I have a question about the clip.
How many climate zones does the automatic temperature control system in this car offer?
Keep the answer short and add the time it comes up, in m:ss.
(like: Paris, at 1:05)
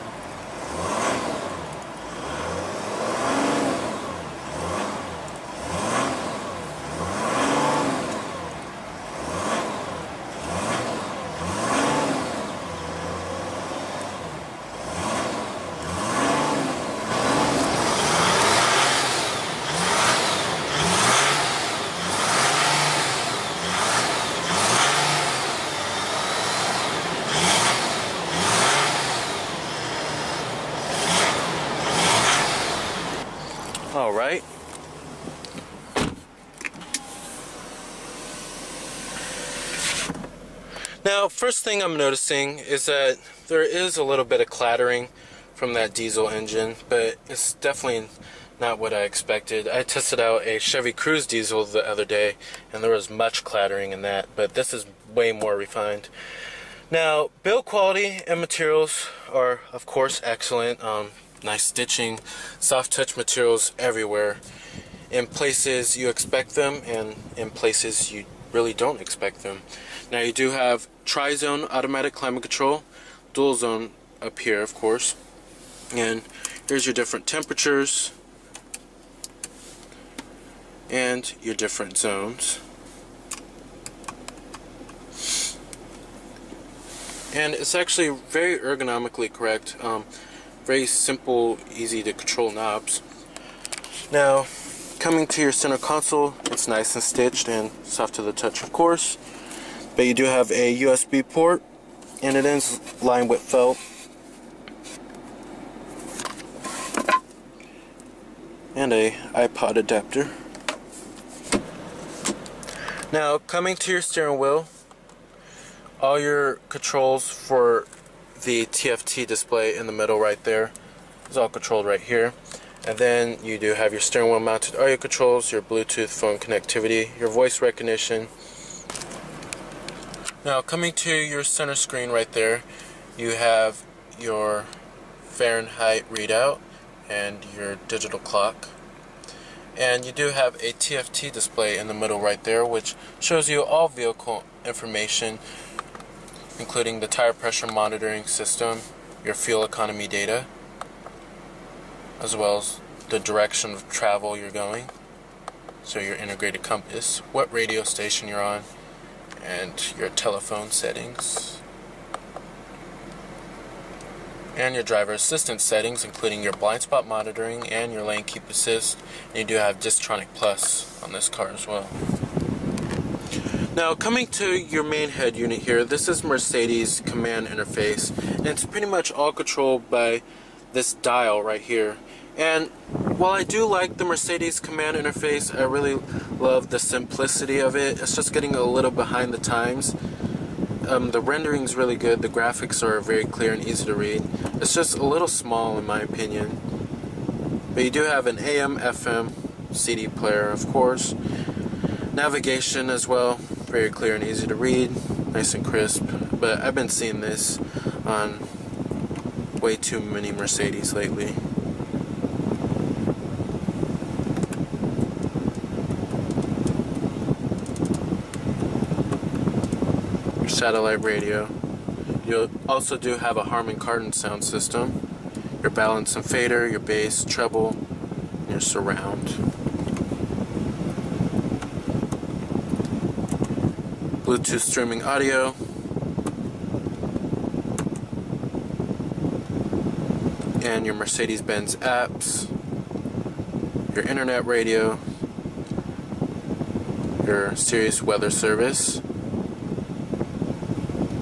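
3 (tri-zone), at 1:11.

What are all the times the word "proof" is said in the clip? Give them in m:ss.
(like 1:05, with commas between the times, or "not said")
not said.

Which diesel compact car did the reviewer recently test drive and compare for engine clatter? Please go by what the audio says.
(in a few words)
Chevy Cruze.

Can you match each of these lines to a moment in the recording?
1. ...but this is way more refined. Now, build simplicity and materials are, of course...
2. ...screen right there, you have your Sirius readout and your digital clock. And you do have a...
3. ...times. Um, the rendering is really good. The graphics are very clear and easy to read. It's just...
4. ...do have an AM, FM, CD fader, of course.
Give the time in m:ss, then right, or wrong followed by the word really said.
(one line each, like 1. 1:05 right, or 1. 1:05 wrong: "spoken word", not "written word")
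1. 0:54 wrong: "quality", not "simplicity"
2. 2:11 wrong: "Fahrenheit", not "Sirius"
3. 3:09 right
4. 3:17 wrong: "player", not "fader".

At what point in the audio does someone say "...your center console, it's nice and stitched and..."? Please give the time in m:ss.
1:35.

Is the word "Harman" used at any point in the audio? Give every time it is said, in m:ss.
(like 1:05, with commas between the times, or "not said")
3:43.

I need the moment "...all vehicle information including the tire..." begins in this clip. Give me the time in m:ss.
2:23.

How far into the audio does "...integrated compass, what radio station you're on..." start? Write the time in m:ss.
2:36.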